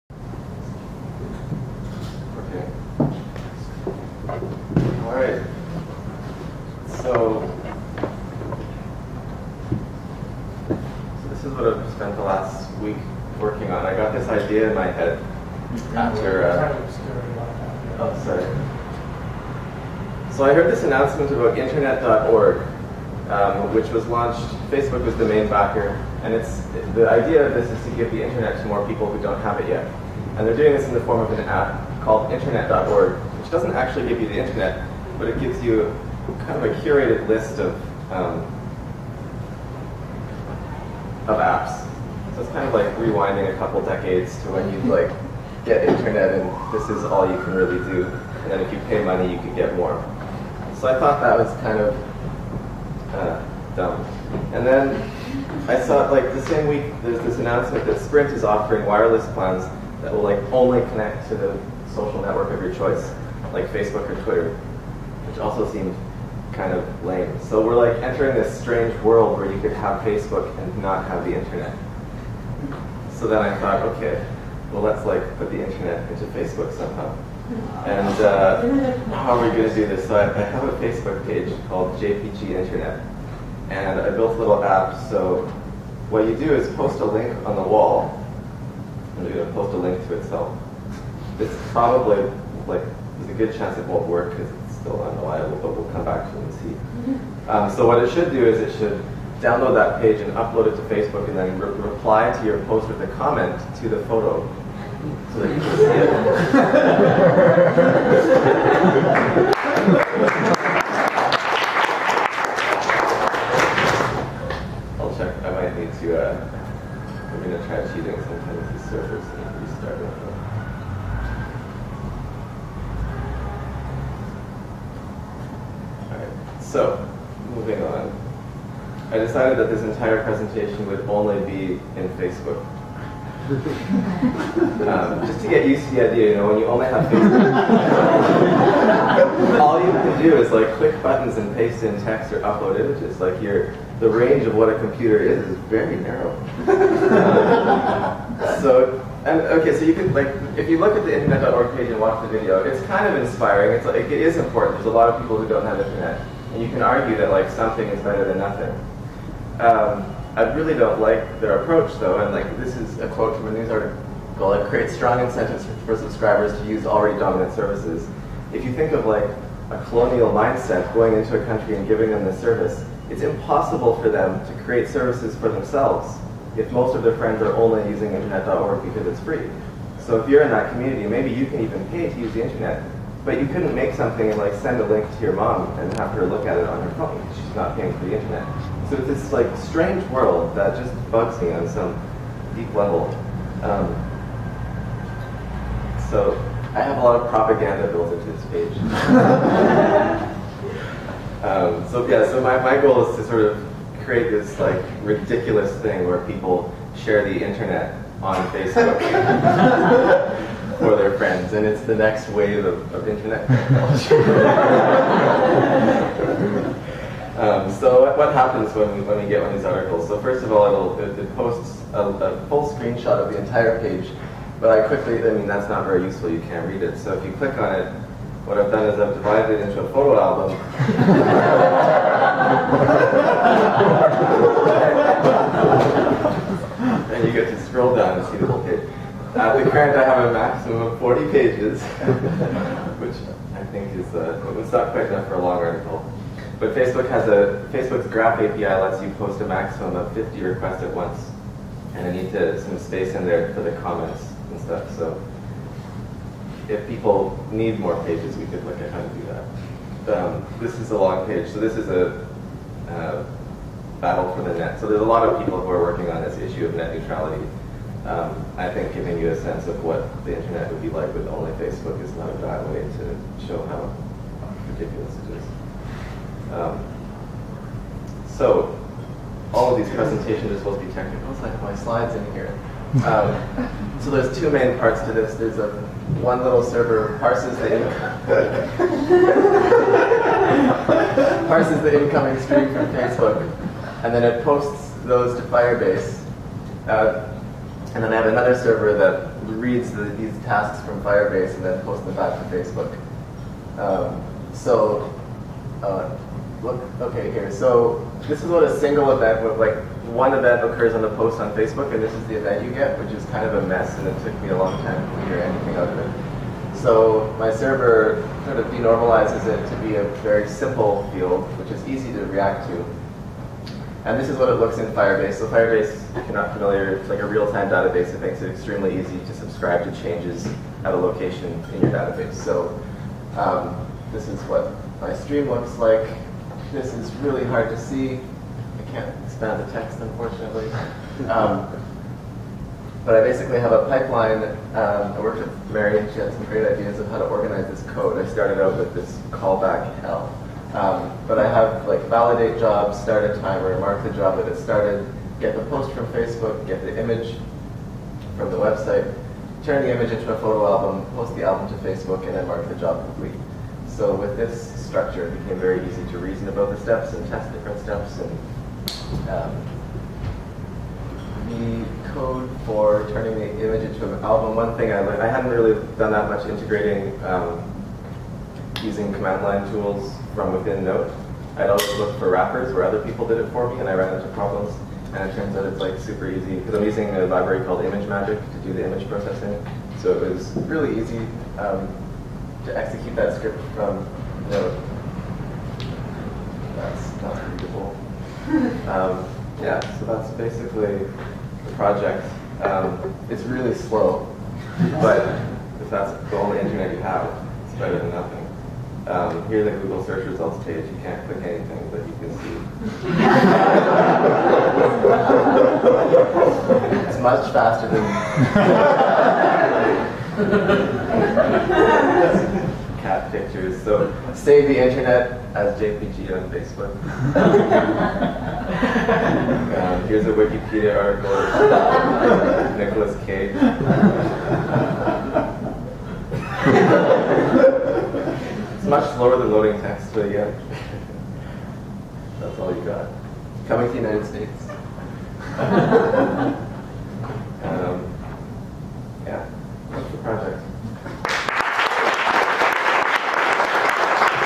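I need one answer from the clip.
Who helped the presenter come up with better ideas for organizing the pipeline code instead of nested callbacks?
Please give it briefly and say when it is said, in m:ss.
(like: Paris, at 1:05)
Mary, at 5:45.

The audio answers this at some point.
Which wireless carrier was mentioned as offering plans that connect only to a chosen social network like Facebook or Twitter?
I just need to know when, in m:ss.
0:57.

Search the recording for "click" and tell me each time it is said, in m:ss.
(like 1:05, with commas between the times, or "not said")
2:20, 3:47, 6:51.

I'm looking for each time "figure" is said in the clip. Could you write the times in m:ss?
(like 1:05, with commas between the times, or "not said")
5:15.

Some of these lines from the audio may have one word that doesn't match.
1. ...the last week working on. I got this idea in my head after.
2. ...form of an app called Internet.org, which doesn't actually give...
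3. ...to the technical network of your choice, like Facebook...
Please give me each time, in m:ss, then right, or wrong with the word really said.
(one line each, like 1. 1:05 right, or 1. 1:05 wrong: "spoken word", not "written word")
1. 0:12 right
2. 0:31 right
3. 1:01 wrong: "social", not "technical".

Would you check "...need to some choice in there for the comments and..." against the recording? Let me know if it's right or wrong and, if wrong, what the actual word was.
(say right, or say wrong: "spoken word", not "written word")
wrong: "space", not "choice".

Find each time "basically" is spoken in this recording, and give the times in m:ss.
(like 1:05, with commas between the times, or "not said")
5:43, 6:40.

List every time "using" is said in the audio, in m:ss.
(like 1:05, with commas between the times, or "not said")
2:57, 6:18, 6:26.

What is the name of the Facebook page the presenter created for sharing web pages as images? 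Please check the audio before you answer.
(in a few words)
JPG Internet.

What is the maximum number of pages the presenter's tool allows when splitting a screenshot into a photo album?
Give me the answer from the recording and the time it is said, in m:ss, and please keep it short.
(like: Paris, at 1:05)
40, at 4:00.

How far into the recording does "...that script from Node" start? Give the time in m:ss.
6:33.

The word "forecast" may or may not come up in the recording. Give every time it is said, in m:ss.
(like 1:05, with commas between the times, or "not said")
not said.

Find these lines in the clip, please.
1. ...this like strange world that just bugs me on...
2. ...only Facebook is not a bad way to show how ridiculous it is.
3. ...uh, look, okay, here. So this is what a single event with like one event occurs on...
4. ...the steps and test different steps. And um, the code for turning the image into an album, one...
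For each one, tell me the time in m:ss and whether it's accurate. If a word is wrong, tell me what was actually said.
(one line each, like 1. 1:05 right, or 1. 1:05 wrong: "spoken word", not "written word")
1. 3:09 right
2. 4:31 right
3. 5:05 right
4. 6:06 right.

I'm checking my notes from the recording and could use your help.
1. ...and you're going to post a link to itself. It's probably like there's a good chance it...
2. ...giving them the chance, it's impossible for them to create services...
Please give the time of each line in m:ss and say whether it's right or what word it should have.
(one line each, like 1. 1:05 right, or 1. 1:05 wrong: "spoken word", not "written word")
1. 1:29 right
2. 2:51 wrong: "service", not "chance".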